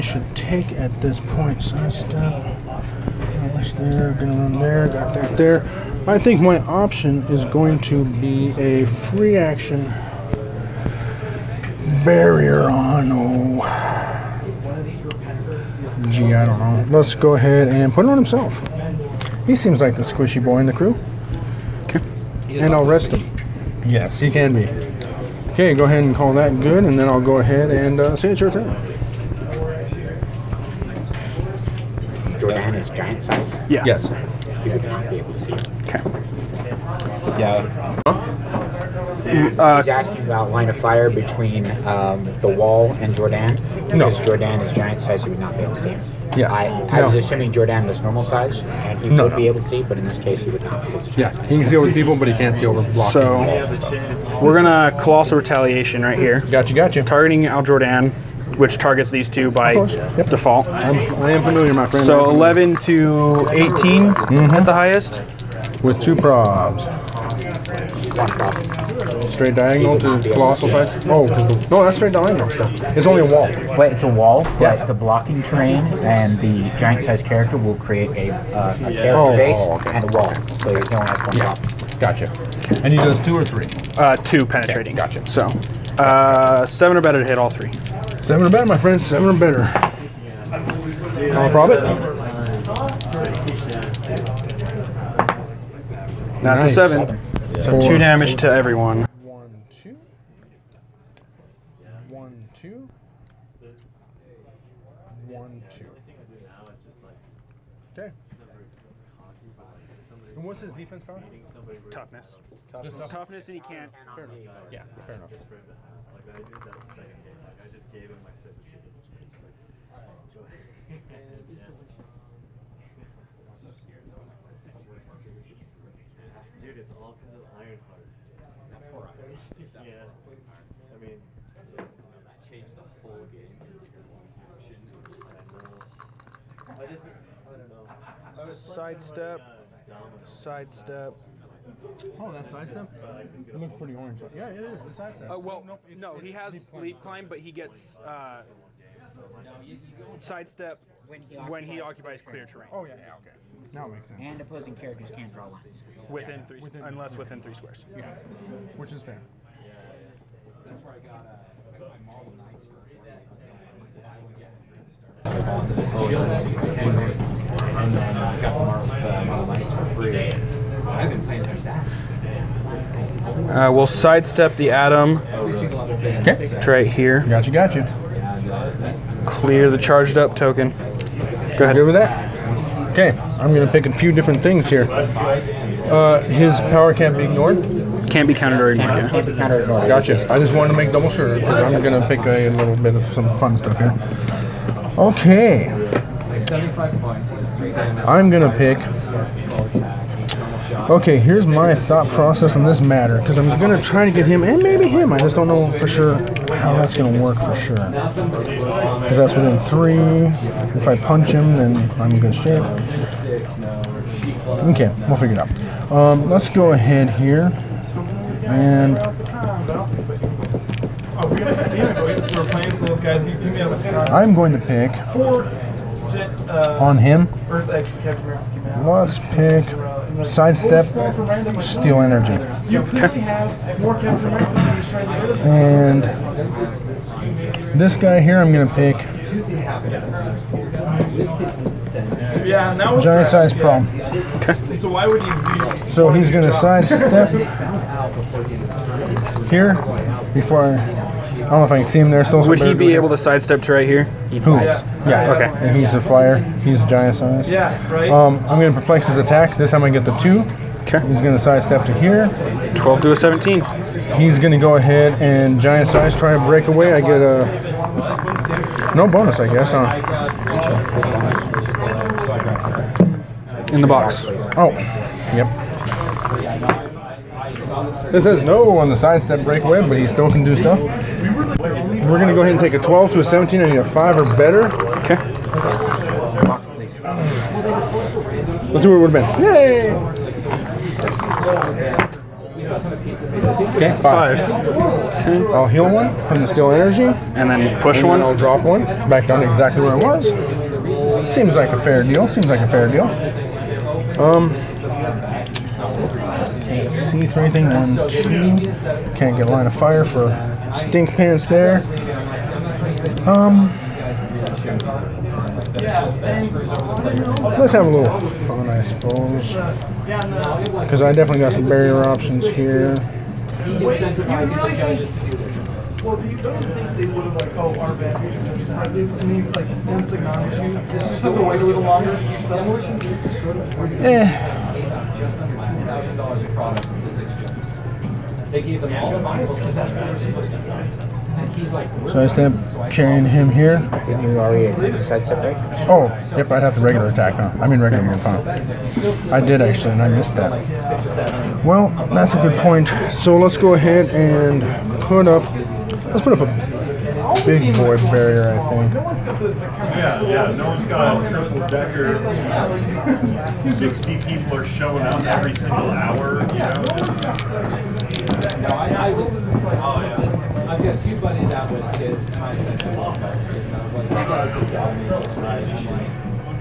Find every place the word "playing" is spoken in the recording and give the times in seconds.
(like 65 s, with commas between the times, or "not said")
171 s.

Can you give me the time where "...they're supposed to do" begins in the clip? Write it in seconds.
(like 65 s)
340 s.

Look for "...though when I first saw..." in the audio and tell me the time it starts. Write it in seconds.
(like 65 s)
124 s.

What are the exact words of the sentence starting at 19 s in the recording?
He seems like the squishy boy in the crew.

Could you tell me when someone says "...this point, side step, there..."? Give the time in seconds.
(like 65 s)
1 s.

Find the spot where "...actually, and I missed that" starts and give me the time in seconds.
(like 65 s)
349 s.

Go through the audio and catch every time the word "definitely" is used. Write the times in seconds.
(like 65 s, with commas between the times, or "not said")
321 s.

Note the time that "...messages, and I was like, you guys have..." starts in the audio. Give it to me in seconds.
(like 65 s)
373 s.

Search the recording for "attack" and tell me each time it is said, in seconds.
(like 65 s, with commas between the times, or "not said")
259 s, 347 s.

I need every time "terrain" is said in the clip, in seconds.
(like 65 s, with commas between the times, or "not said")
75 s, 152 s.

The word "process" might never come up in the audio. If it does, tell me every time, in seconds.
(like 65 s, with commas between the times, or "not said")
202 s.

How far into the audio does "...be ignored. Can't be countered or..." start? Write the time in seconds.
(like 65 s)
187 s.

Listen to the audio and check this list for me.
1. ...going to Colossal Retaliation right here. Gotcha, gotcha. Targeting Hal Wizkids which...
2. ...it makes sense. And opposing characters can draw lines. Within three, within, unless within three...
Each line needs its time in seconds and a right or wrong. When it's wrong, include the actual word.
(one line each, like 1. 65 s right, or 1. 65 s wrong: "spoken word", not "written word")
1. 54 s wrong: "Jordan", not "Wizkids"
2. 153 s right.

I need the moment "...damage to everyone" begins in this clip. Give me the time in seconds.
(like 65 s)
97 s.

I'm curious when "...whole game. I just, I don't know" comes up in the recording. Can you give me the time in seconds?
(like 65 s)
132 s.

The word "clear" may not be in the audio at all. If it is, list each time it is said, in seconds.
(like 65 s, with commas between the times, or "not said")
152 s, 179 s.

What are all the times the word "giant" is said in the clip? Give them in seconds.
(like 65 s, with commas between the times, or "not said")
32 s, 44 s, 76 s, 243 s, 256 s, 265 s.